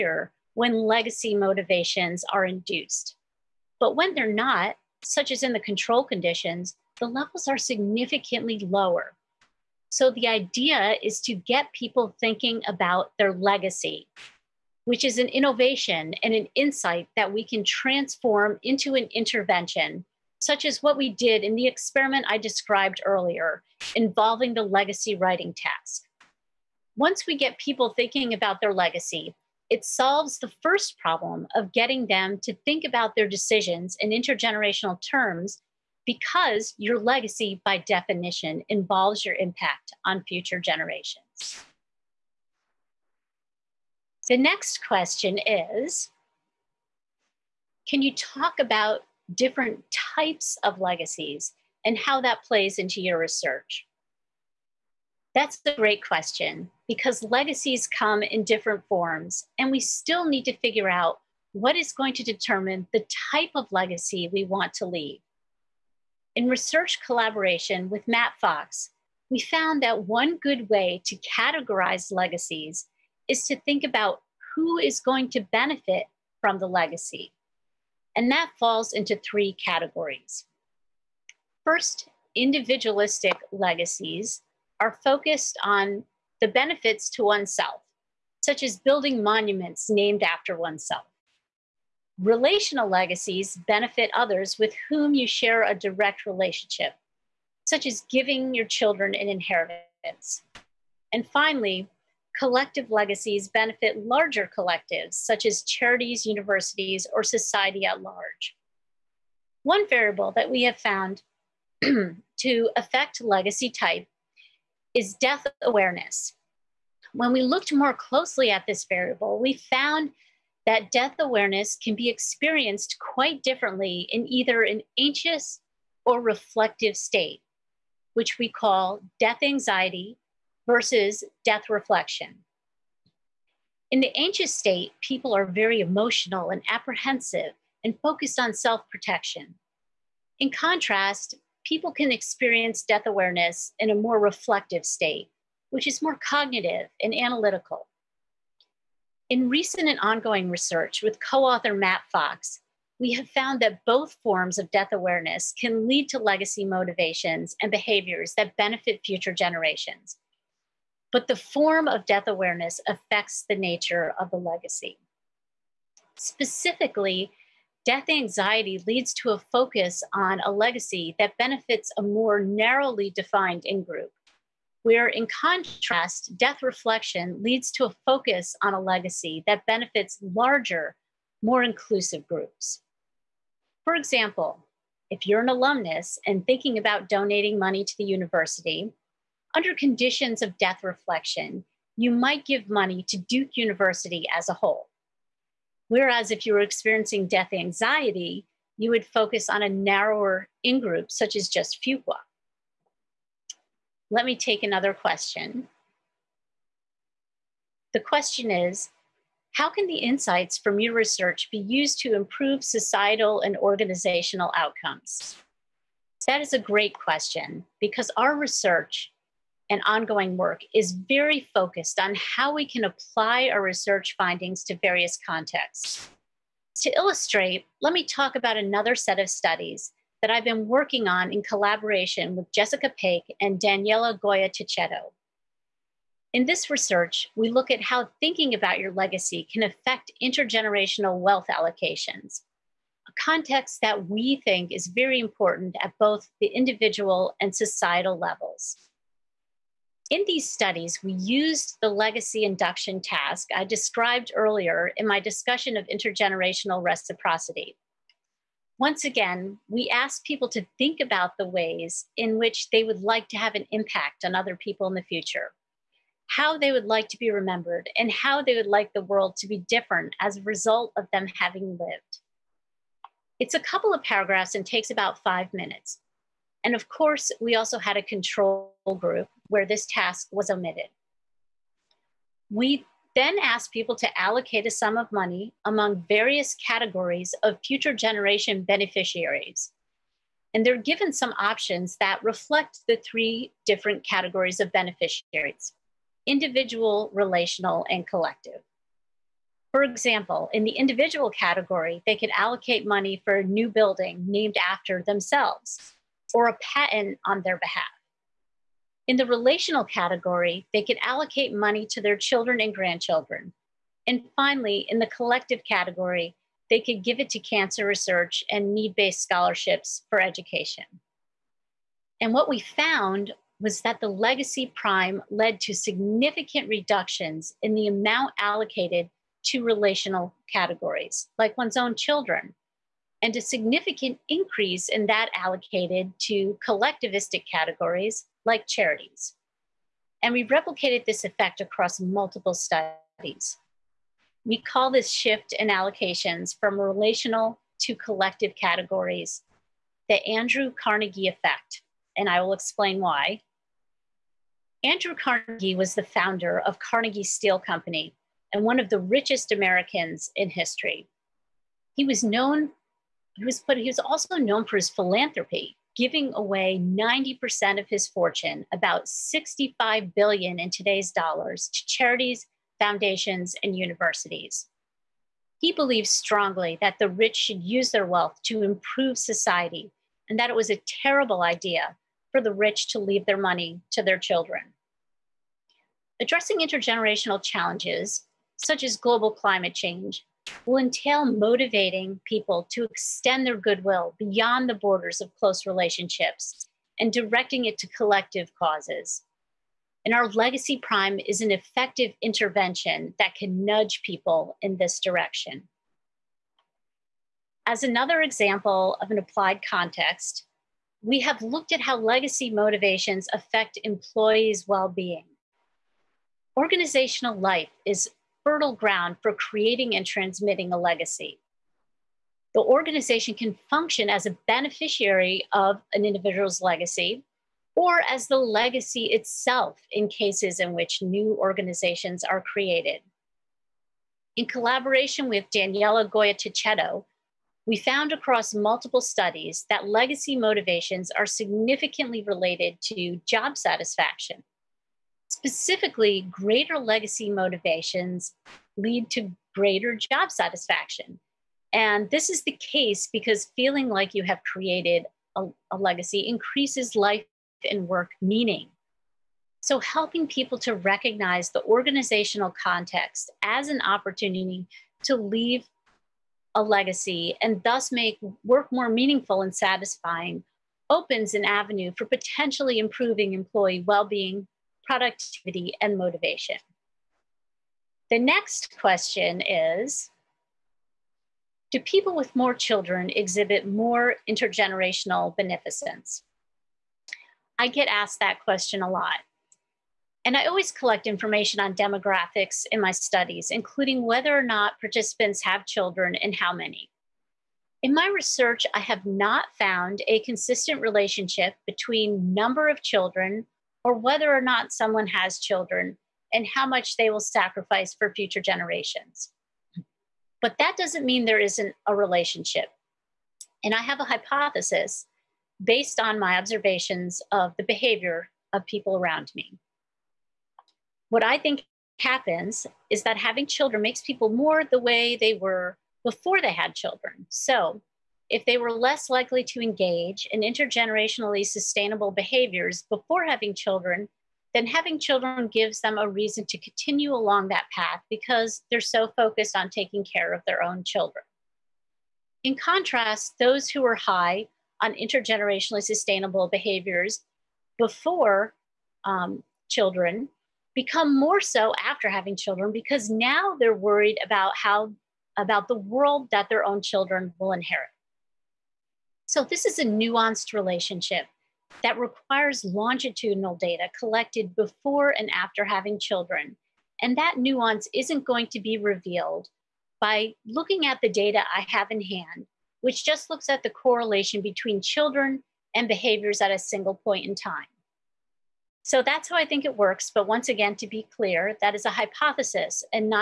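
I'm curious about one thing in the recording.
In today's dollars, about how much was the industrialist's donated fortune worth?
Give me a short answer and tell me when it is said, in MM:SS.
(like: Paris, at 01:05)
65 billion, at 06:09.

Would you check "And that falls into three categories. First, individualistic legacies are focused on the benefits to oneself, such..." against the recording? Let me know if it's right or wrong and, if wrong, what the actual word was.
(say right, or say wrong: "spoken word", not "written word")
right.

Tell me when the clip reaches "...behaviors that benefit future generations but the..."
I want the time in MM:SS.
02:37.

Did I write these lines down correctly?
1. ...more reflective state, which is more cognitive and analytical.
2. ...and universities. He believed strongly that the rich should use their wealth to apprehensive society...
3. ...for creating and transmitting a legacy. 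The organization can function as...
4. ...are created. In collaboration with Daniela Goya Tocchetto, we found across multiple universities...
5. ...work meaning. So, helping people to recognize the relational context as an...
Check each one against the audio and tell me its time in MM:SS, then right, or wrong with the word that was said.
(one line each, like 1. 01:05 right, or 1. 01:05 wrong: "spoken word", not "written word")
1. 02:23 right
2. 06:13 wrong: "improve", not "apprehensive"
3. 06:59 right
4. 07:12 wrong: "studies", not "universities"
5. 07:37 wrong: "organizational", not "relational".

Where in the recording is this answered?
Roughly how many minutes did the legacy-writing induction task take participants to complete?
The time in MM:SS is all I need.
04:35.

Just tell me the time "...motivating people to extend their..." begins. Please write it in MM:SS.
06:31.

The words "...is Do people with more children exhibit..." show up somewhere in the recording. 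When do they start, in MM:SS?
07:59.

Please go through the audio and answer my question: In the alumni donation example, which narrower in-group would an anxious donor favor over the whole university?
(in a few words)
Fuqua.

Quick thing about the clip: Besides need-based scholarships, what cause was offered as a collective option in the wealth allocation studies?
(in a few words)
cancer research.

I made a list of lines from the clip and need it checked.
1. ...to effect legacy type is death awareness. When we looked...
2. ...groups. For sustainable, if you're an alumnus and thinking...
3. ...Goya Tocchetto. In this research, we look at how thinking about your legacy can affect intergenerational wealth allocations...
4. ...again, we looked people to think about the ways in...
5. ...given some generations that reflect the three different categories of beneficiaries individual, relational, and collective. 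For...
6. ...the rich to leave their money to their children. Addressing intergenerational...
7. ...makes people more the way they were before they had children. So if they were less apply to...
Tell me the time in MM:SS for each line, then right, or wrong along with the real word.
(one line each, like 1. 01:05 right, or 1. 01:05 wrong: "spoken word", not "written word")
1. 01:51 wrong: "affect", not "effect"
2. 03:02 wrong: "example", not "sustainable"
3. 03:54 right
4. 04:19 wrong: "asked", not "looked"
5. 04:50 wrong: "options", not "generations"
6. 06:22 right
7. 08:43 wrong: "likely", not "apply".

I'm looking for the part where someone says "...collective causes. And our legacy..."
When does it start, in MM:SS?
06:37.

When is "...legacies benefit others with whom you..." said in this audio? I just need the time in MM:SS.
01:32.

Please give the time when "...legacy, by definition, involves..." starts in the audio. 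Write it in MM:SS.
00:36.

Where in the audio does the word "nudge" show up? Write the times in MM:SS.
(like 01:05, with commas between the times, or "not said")
06:43.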